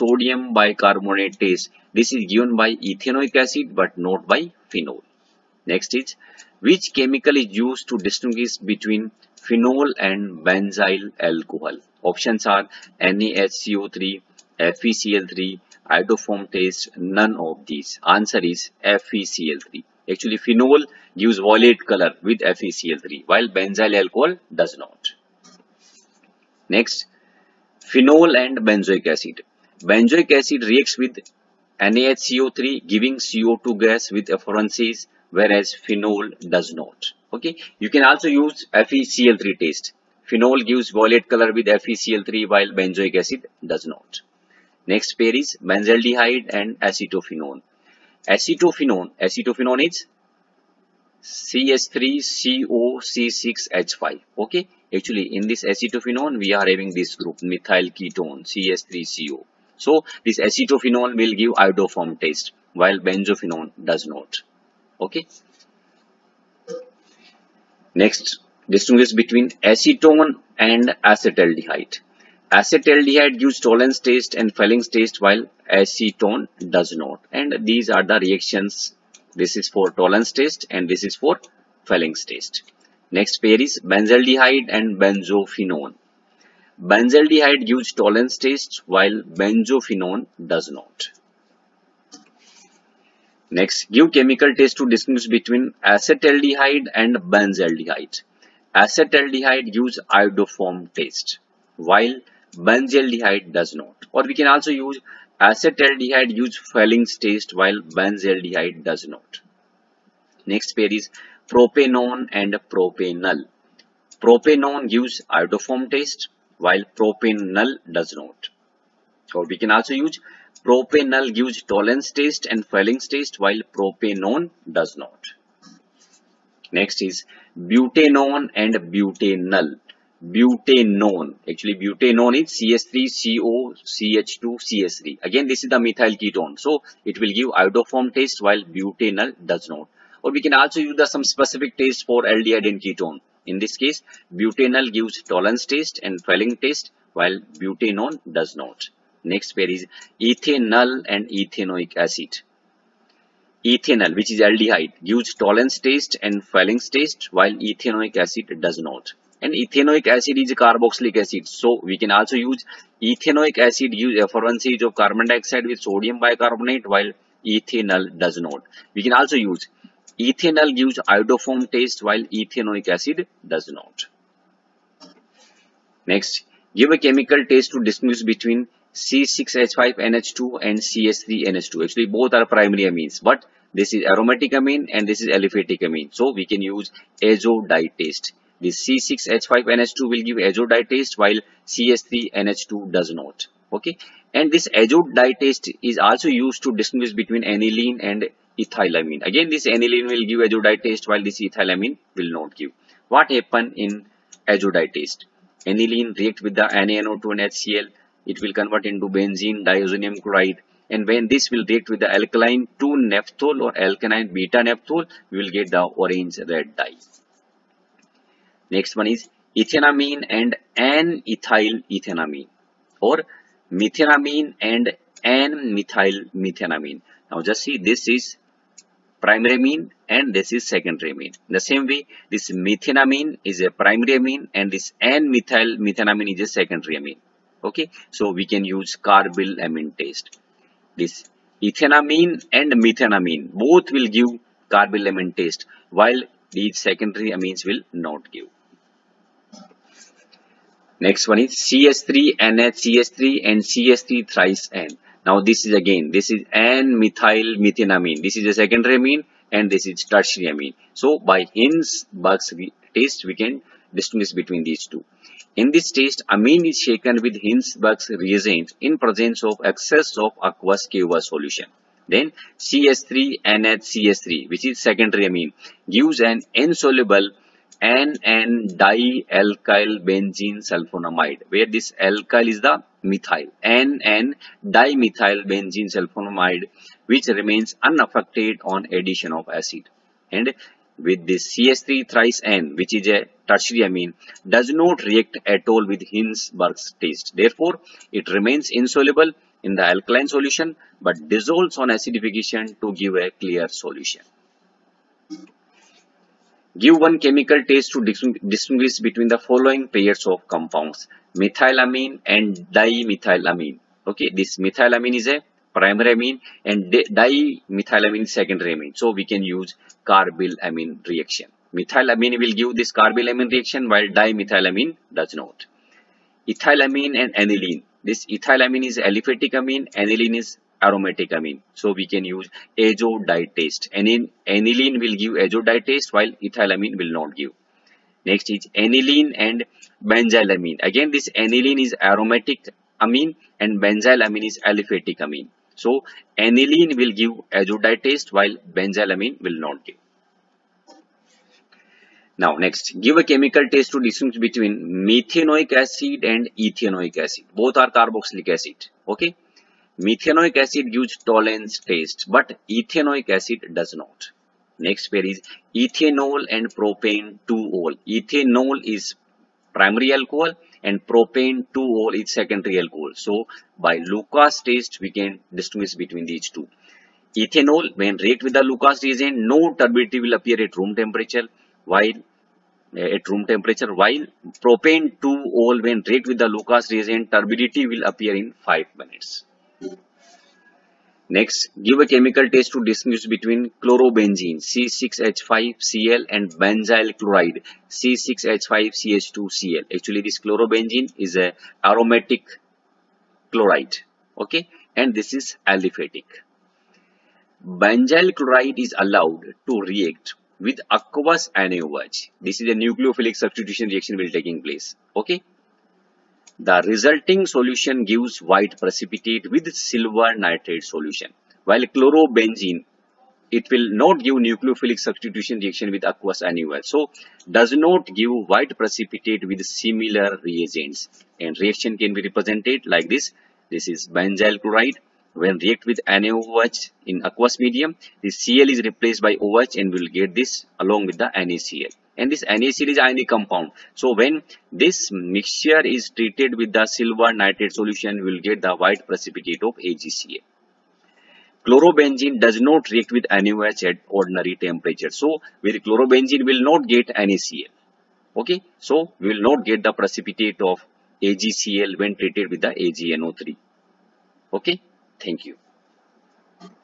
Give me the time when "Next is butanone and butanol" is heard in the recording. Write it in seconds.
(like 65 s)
126 s.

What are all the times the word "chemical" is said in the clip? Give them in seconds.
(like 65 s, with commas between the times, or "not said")
6 s, 94 s, 176 s, 307 s, 353 s, 392 s.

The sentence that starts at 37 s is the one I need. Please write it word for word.
Okay, you can also use FeCl3 test.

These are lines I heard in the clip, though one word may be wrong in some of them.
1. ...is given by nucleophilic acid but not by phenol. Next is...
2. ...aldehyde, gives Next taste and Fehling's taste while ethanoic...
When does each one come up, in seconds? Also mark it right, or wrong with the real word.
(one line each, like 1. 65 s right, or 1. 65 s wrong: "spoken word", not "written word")
1. 2 s wrong: "ethanoic", not "nucleophilic"
2. 154 s wrong: "Tollens", not "Next".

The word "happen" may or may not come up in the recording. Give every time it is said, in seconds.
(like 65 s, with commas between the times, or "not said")
203 s.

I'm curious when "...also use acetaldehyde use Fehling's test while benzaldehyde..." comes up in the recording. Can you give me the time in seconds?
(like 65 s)
104 s.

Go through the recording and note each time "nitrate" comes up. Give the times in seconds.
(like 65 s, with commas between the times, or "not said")
420 s, 447 s.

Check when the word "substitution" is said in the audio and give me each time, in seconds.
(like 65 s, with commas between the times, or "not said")
413 s, 424 s.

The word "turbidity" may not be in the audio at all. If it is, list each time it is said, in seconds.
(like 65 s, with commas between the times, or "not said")
379 s, 387 s.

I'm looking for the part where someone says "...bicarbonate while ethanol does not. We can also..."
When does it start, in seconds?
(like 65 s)
166 s.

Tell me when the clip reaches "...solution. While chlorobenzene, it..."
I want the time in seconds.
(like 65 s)
420 s.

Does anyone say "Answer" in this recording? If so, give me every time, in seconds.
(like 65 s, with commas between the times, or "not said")
18 s.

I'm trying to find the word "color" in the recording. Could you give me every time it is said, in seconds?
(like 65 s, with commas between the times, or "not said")
21 s, 41 s.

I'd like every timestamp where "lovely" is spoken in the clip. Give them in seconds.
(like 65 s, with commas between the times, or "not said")
not said.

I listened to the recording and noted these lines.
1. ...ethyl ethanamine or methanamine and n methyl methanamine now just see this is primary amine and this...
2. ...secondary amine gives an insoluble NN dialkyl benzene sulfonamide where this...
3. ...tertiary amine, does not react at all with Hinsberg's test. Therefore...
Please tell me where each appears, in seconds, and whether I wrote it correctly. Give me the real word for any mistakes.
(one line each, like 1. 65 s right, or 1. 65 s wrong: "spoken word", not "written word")
1. 221 s right
2. 274 s right
3. 293 s right.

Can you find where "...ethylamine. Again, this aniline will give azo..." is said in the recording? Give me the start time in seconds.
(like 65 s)
198 s.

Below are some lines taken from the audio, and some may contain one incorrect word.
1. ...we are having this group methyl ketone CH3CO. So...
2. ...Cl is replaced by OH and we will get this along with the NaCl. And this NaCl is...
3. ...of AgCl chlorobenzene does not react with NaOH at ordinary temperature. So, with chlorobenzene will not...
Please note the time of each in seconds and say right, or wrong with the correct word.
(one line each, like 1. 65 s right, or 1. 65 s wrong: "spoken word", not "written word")
1. 56 s right
2. 438 s right
3. 449 s right.